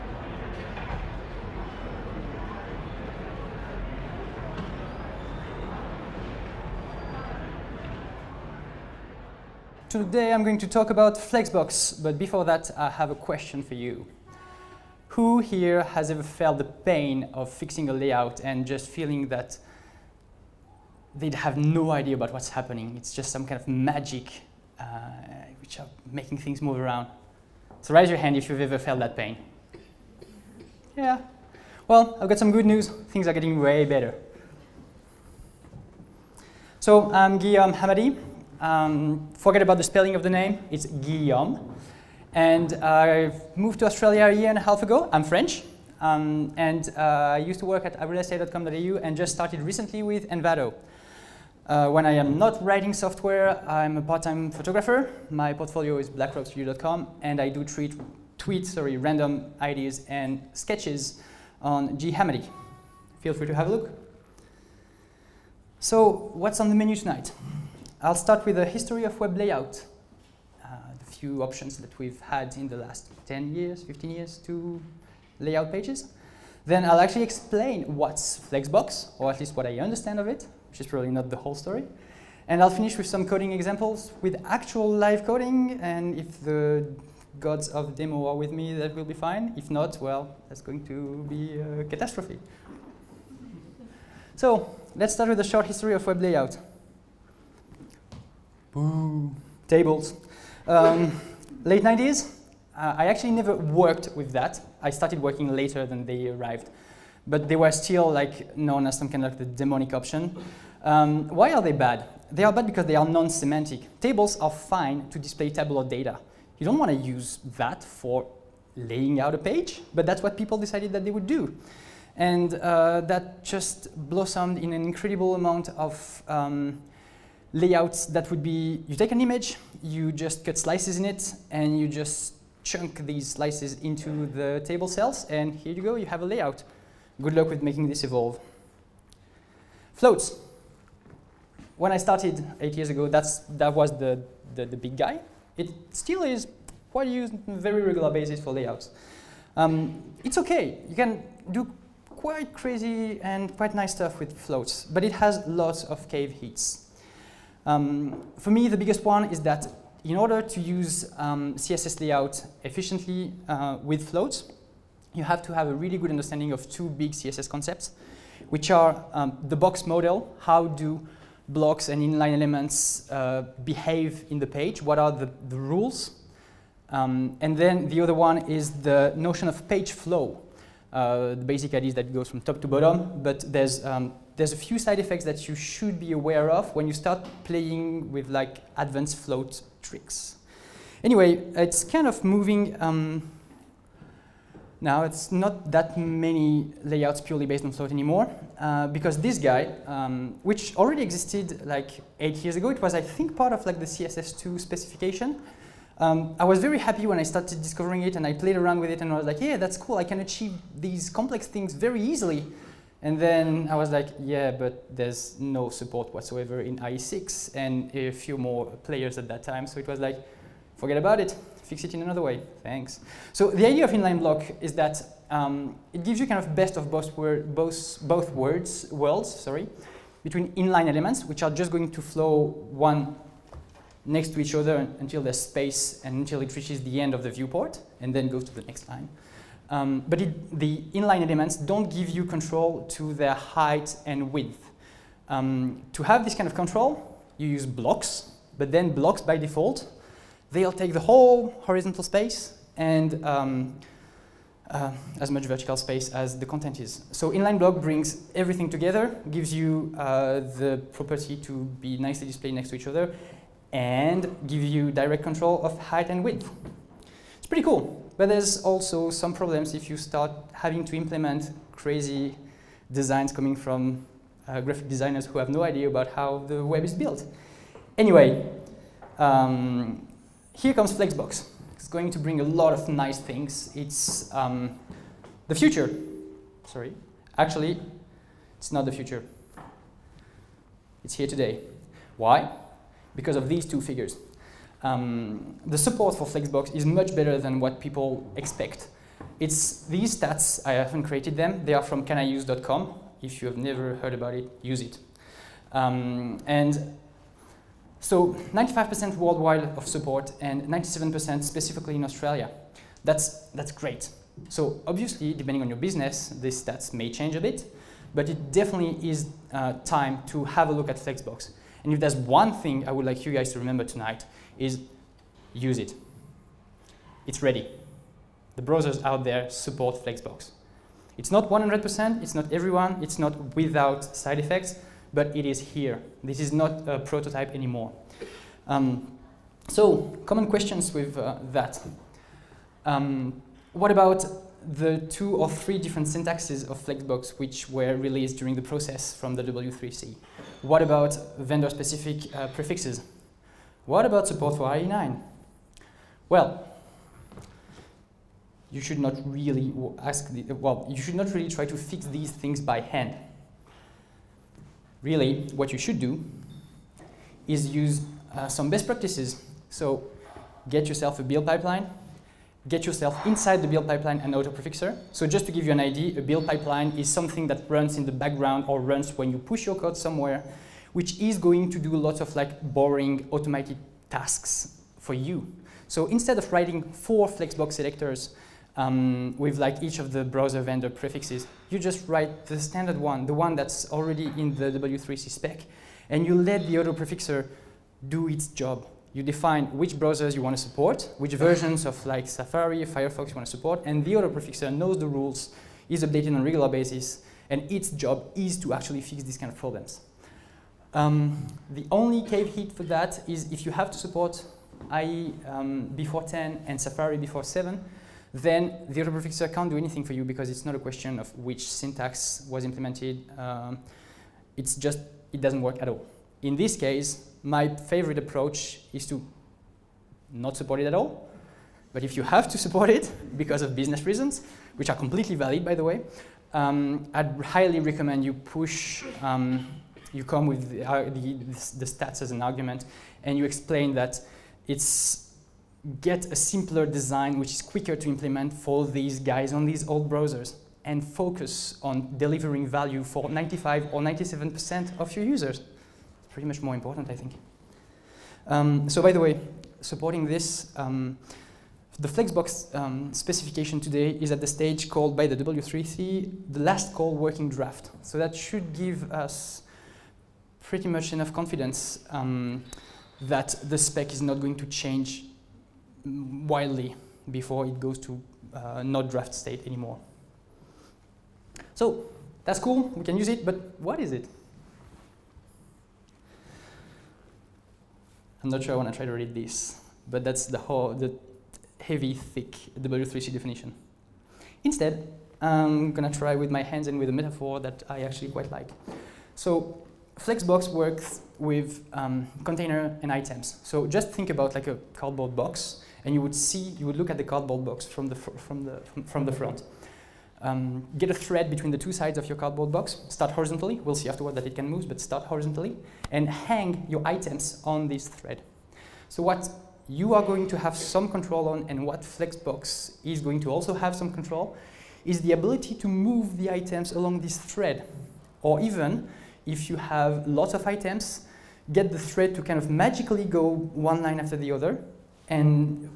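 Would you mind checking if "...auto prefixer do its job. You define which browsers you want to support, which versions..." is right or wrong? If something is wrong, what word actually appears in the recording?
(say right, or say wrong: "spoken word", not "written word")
right.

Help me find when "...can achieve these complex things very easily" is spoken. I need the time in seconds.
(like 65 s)
210 s.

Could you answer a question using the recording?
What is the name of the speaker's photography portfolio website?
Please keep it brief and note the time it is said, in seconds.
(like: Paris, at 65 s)
blackrockstudio.com, at 56 s.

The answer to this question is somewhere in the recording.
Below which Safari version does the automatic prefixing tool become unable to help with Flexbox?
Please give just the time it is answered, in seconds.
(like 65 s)
416 s.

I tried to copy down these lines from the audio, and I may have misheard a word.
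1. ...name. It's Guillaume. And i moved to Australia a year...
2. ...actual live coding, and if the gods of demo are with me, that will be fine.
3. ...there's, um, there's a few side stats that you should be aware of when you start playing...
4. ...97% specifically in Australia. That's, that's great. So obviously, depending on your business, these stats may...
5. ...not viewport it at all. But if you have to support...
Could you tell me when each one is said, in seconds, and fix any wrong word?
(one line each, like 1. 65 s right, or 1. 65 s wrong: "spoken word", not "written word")
1. 40 s right
2. 84 s right
3. 183 s wrong: "effects", not "stats"
4. 310 s right
5. 430 s wrong: "support", not "viewport".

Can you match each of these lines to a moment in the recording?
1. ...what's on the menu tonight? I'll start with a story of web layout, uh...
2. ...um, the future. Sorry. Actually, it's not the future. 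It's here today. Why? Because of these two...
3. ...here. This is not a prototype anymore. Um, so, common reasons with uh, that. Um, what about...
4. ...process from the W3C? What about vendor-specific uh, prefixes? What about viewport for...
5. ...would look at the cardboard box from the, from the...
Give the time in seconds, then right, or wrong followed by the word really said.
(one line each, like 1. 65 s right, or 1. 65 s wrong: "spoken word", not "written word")
1. 66 s wrong: "history", not "story"
2. 284 s right
3. 335 s wrong: "questions", not "reasons"
4. 348 s wrong: "support", not "viewport"
5. 506 s right.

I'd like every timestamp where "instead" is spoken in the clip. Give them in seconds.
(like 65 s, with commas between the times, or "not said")
386 s, 494 s.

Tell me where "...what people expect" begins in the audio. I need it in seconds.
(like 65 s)
297 s.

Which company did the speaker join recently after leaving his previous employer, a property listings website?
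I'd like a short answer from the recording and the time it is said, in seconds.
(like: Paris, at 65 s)
Envato, at 50 s.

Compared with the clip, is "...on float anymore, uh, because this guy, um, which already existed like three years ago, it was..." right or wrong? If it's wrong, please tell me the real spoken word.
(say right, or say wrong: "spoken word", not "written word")
wrong: "eight", not "three".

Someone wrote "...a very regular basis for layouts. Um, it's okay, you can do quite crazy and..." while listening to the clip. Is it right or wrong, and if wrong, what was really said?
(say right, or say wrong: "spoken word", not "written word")
right.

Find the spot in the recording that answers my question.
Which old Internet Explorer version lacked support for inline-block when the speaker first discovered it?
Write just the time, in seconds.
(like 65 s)
216 s.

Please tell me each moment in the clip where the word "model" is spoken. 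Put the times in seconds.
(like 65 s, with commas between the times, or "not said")
169 s.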